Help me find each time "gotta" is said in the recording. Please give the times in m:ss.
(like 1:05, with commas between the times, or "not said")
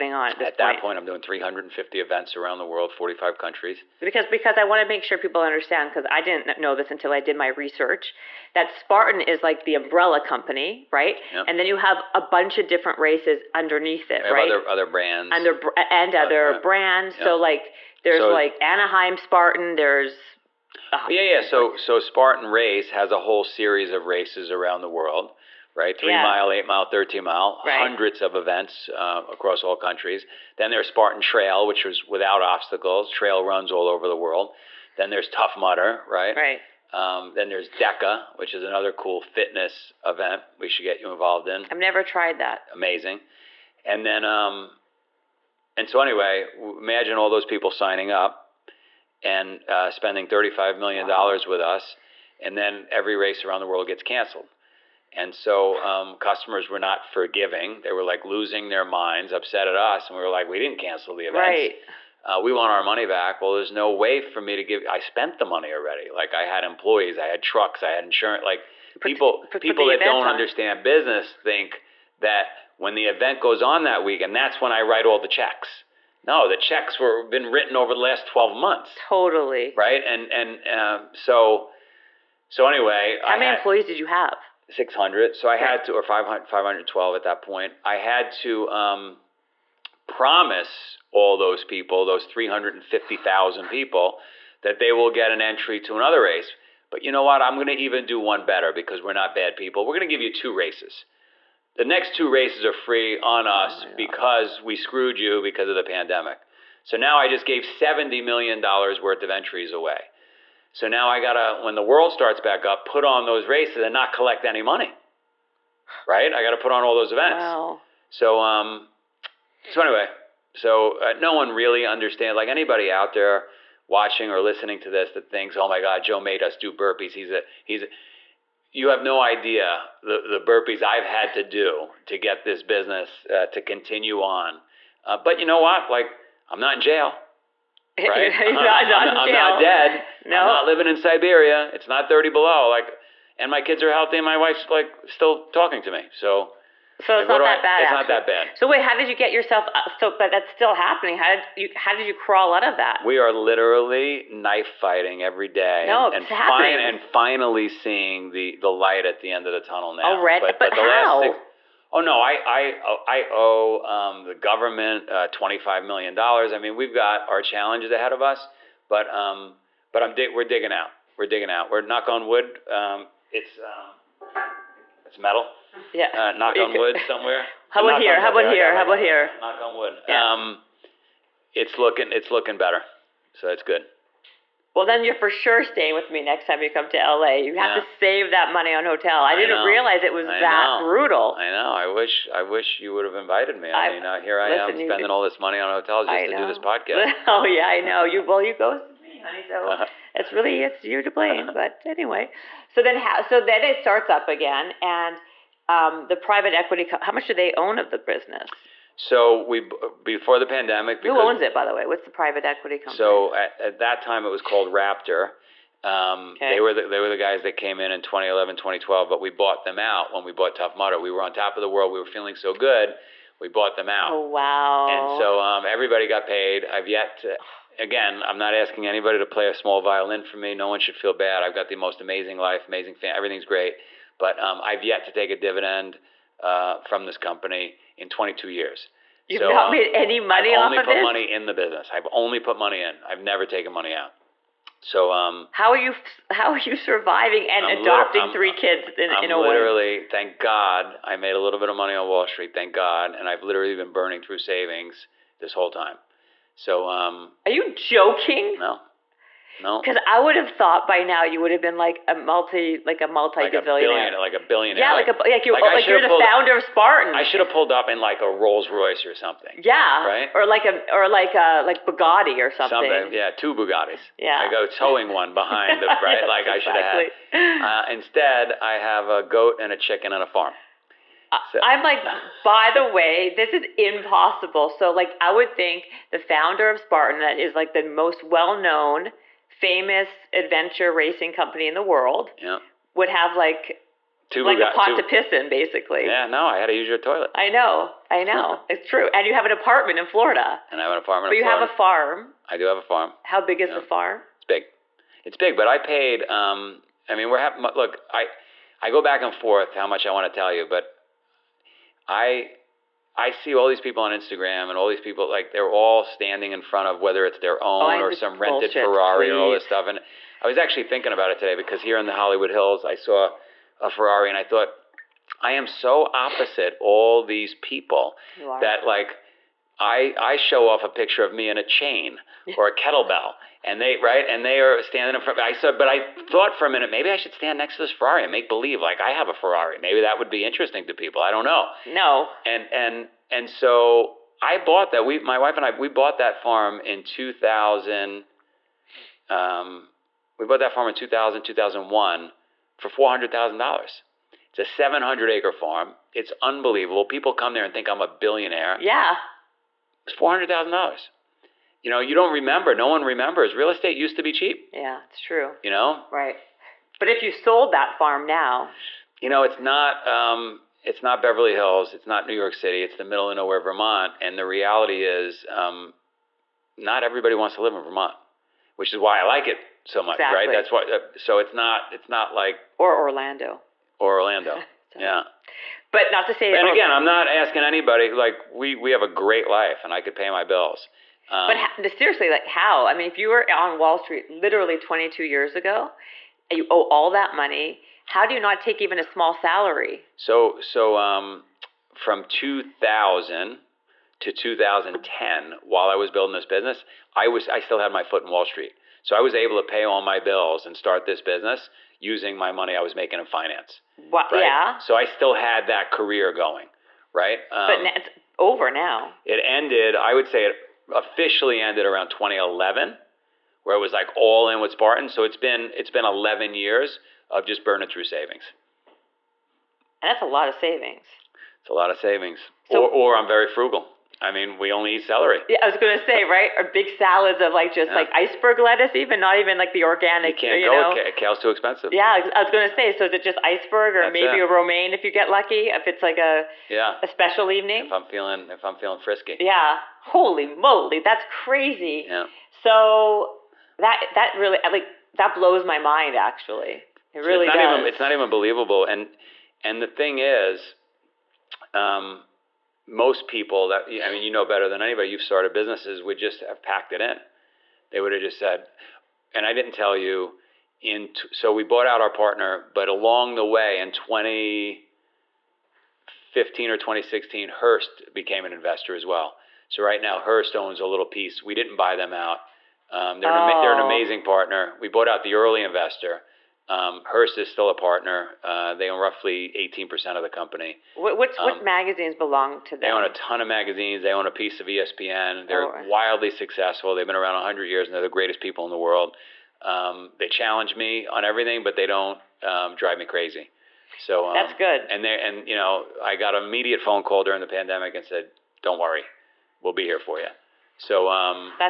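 1:51, 1:56.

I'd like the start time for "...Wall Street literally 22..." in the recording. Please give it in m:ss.
6:33.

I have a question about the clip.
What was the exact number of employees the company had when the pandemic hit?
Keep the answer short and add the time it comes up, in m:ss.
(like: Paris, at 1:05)
512, at 1:26.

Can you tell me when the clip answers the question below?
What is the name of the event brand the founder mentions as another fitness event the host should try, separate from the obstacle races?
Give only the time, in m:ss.
0:37.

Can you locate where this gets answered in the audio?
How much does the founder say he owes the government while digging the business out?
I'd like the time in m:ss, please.
2:45.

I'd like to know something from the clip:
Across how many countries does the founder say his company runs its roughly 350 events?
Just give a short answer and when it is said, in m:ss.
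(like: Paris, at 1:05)
45, at 0:02.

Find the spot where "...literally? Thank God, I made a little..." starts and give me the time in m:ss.
4:09.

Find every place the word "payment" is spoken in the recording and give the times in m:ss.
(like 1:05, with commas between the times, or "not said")
not said.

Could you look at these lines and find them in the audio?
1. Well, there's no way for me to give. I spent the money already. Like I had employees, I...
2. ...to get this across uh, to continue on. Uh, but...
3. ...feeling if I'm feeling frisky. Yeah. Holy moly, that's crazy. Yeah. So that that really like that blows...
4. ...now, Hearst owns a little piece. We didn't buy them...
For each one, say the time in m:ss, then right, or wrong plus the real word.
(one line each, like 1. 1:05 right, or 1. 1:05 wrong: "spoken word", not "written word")
1. 1:03 right
2. 2:12 wrong: "business", not "across"
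3. 7:28 right
4. 7:59 right.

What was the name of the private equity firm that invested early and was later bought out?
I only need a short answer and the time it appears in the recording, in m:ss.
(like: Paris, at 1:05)
Raptor, at 3:34.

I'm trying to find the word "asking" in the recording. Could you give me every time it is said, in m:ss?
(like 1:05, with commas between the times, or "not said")
3:48, 6:27.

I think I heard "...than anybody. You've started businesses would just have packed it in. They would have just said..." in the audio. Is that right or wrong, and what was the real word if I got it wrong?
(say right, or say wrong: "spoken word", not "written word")
right.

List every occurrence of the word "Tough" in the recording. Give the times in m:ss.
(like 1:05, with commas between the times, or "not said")
0:35, 3:40.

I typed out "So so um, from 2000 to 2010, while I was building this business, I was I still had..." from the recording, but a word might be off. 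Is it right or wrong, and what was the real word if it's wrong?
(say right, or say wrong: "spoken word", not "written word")
right.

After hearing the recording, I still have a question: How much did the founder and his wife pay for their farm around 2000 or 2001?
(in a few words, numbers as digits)
$400,000.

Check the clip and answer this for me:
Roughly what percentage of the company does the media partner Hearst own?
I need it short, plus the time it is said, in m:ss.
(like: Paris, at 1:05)
18%, at 8:09.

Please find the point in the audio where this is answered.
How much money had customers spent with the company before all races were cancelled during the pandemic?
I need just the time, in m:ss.
0:50.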